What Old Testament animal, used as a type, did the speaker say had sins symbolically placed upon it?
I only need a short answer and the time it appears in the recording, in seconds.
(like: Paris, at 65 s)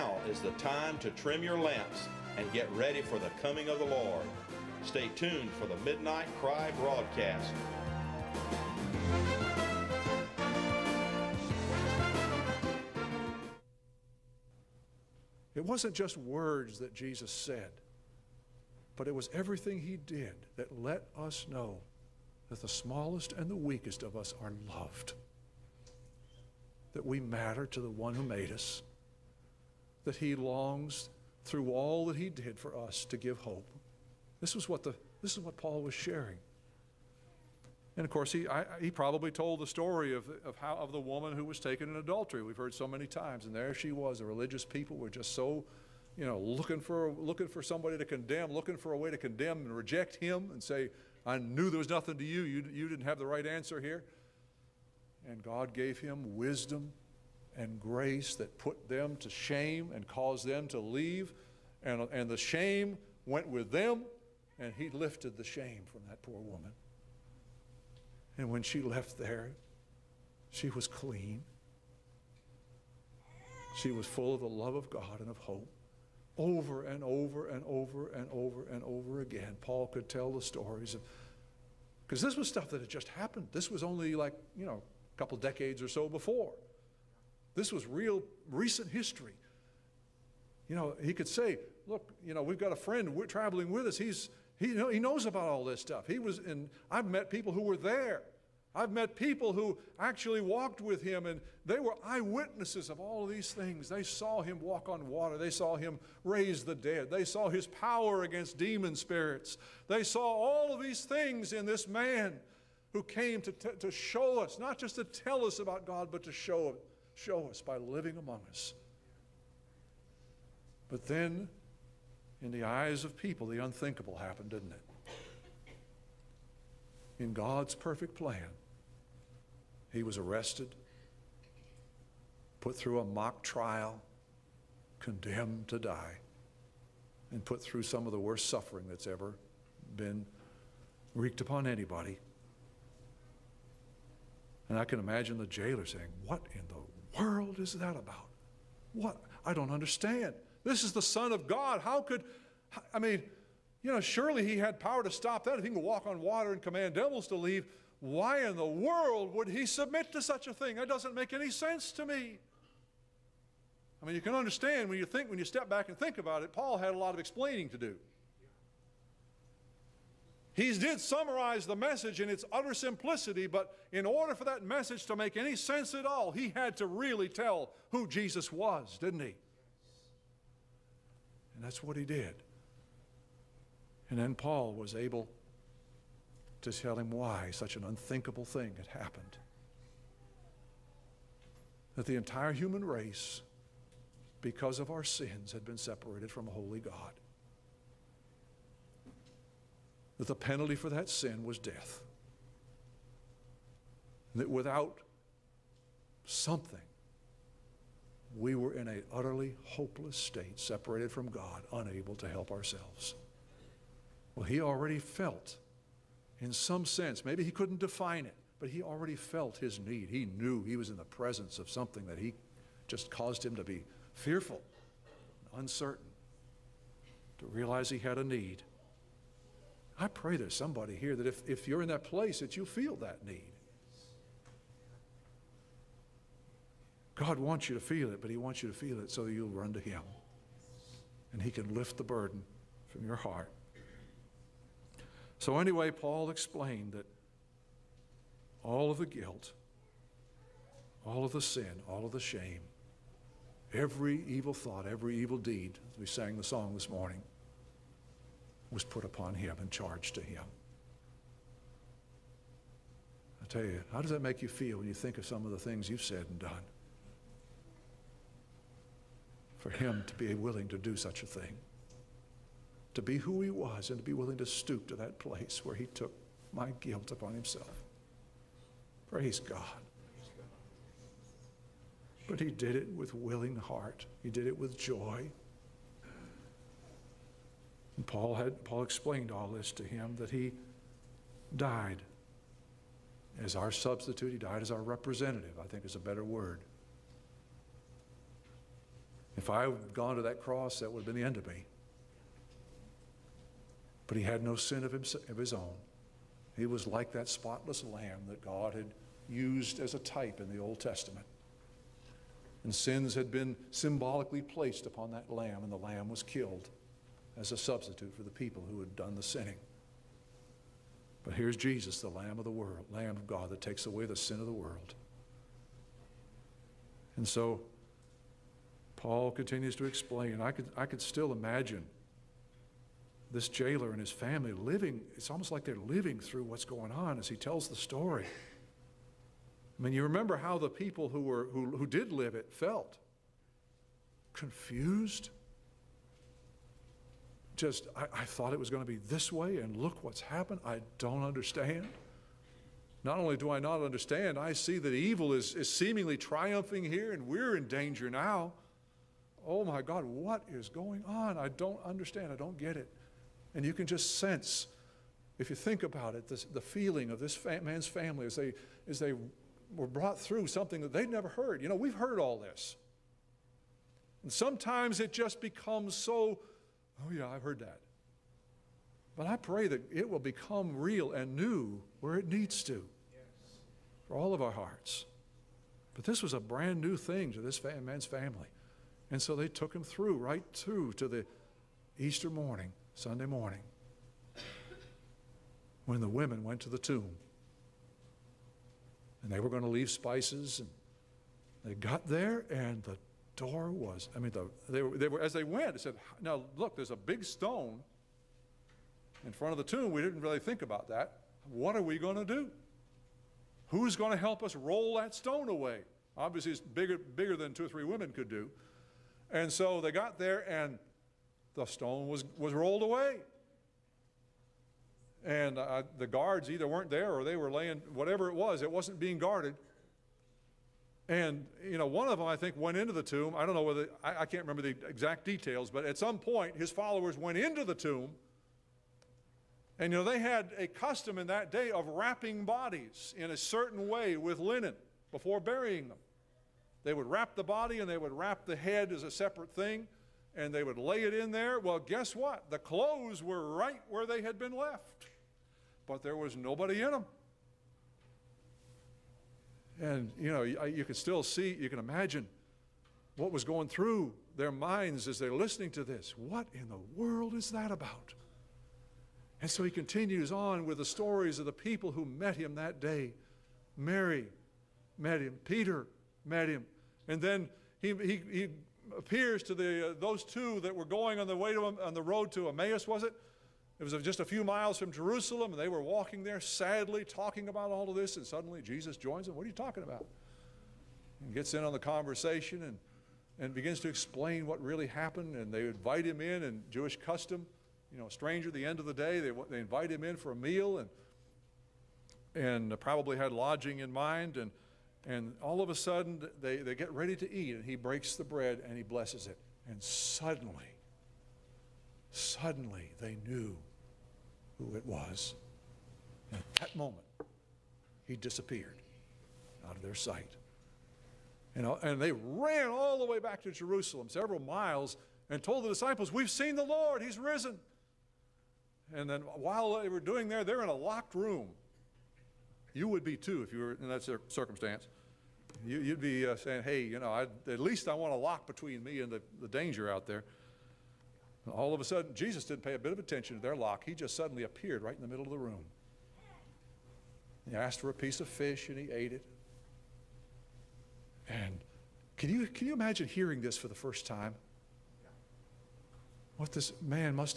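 spotless lamb, at 307 s.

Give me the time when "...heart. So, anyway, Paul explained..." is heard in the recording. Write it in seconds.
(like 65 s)
243 s.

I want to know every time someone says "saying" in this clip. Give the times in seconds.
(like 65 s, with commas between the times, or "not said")
145 s, 536 s.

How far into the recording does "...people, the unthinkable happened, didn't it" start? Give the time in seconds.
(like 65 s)
123 s.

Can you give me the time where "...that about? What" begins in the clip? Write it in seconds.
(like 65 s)
147 s.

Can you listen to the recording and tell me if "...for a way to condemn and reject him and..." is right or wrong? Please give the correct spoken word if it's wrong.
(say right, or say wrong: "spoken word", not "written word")
right.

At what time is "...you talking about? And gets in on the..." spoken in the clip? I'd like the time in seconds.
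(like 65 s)
489 s.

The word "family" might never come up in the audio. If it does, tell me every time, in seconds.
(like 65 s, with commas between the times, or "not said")
334 s, 367 s, 388 s.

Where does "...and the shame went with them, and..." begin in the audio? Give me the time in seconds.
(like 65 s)
62 s.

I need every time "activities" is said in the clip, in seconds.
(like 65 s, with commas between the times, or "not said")
not said.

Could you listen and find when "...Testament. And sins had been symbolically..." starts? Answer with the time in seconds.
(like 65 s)
310 s.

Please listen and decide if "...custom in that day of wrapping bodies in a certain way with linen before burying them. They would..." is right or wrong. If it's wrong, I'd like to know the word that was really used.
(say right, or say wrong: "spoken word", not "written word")
right.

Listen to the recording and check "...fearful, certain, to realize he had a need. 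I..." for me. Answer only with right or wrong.
wrong.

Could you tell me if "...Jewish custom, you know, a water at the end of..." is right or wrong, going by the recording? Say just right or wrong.
wrong.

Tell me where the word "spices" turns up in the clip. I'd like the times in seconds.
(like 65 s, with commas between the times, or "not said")
399 s.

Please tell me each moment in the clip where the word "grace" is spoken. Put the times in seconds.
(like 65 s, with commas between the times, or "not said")
57 s.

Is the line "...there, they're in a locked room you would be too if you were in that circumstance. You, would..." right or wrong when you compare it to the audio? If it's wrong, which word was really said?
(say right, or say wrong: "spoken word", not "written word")
right.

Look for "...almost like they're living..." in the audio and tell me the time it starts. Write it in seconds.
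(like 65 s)
335 s.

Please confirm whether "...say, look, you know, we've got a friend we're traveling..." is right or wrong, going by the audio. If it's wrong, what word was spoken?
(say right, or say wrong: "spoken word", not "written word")
right.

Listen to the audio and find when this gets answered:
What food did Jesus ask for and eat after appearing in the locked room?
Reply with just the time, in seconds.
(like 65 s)
548 s.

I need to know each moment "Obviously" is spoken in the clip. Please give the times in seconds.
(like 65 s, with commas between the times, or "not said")
416 s.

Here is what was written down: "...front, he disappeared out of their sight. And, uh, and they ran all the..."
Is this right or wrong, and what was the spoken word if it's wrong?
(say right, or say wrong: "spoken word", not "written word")
wrong: "moment", not "front".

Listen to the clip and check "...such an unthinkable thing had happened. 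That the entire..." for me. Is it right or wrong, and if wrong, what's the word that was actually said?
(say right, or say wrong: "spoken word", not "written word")
right.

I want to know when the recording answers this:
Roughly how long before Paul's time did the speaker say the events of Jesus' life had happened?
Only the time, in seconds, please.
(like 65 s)
84 s.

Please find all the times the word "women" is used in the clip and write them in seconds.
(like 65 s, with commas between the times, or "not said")
396 s, 417 s.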